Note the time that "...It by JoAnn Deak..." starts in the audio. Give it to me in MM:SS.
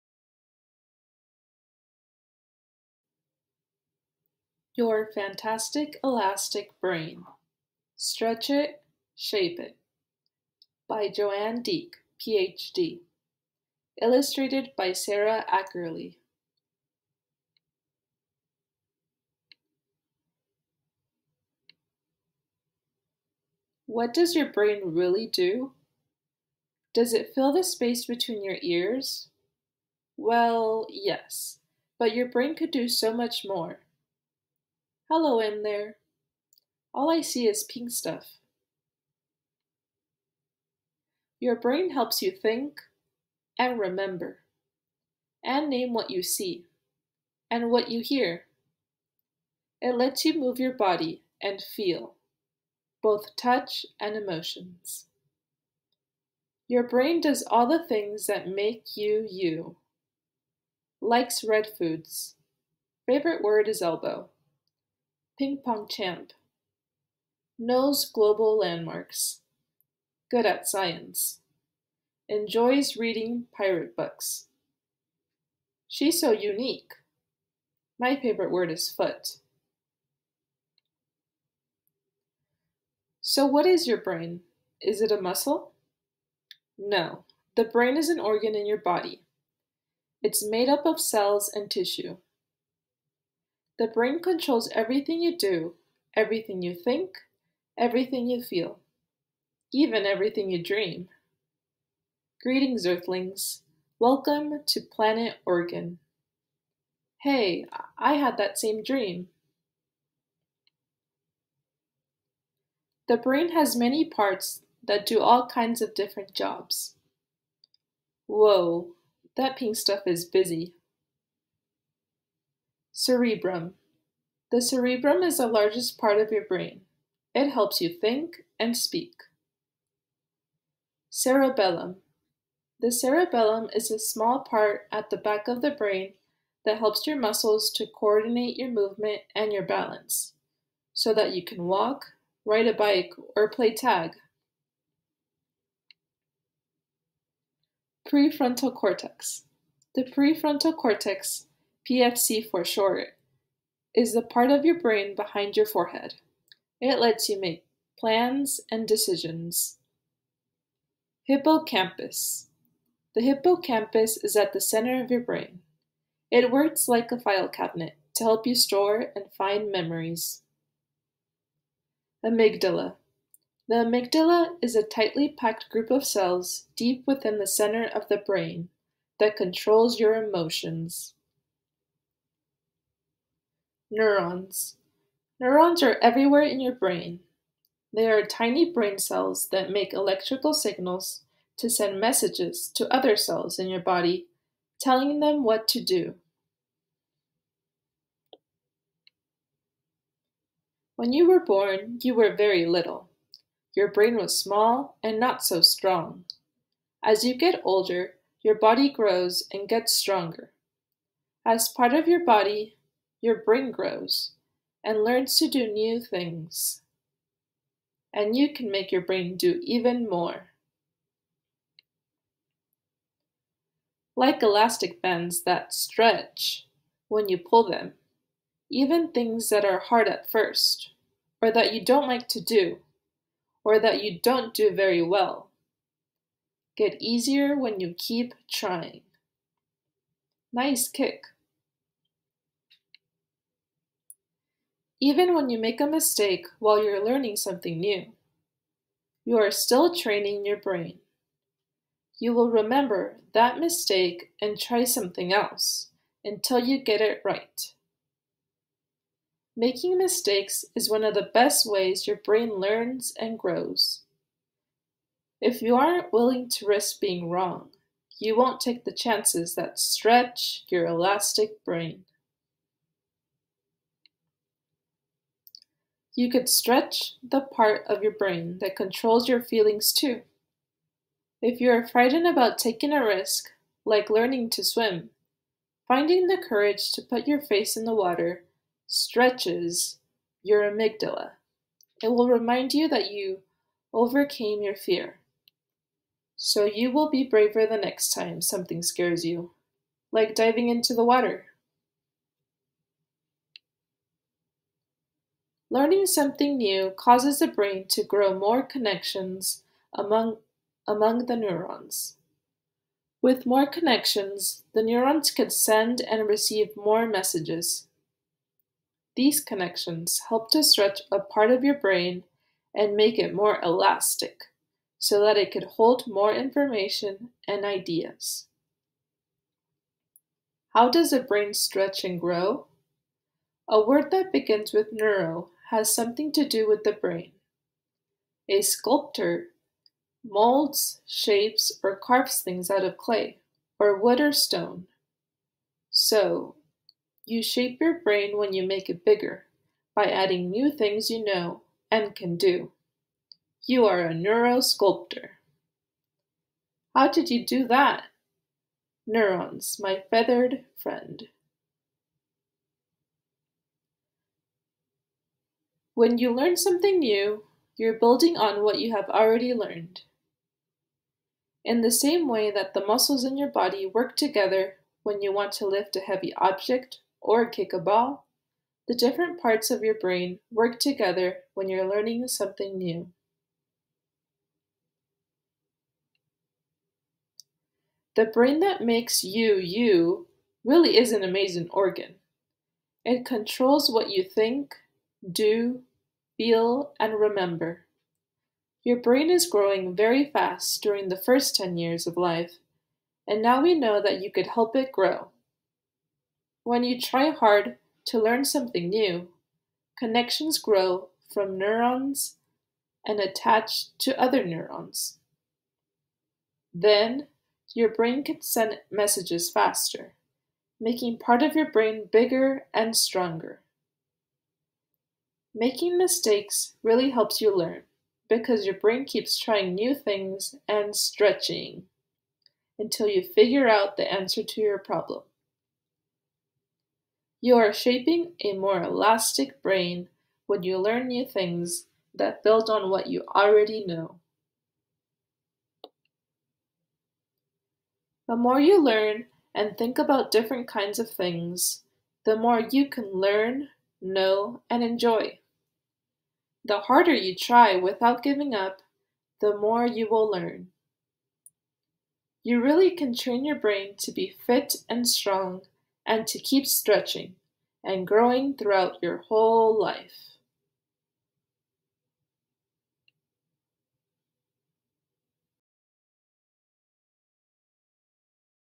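00:09.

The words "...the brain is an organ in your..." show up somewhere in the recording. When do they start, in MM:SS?
01:27.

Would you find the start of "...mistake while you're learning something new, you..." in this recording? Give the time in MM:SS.
04:05.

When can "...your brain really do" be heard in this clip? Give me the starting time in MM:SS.
00:24.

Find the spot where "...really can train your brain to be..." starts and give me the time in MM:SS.
07:42.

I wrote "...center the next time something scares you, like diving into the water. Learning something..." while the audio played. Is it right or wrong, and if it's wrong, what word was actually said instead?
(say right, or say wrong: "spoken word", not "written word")
wrong: "braver", not "center".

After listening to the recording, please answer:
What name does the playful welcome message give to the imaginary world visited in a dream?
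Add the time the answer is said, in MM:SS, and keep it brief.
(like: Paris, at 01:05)
Planet Organ, at 01:44.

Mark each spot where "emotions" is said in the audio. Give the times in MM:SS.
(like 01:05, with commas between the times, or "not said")
00:54, 03:00.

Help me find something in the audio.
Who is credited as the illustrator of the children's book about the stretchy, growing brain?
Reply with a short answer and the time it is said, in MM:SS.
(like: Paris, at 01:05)
Sarah Ackerley, at 00:14.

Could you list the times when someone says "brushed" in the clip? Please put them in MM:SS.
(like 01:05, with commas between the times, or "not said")
not said.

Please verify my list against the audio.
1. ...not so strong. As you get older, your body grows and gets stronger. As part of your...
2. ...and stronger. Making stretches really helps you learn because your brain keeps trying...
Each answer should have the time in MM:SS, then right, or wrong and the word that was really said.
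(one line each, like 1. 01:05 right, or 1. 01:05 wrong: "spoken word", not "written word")
1. 03:25 right
2. 07:02 wrong: "mistakes", not "stretches".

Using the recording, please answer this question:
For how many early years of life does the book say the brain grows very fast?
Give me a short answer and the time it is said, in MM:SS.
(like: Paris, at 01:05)
10, at 06:41.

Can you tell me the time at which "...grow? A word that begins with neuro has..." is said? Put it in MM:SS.
05:32.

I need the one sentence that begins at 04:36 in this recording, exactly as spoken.
You could stretch the part of your brain that controls your feelings too.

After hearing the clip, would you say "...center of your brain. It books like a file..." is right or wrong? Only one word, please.
wrong.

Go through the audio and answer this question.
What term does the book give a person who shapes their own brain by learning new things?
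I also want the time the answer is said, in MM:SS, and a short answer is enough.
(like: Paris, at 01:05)
neurosculptor, at 05:54.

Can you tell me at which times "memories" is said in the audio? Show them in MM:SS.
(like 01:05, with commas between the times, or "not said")
02:49.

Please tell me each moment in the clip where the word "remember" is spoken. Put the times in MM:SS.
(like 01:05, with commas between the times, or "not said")
00:43, 04:12, 06:37.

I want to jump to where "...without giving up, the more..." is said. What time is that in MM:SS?
07:37.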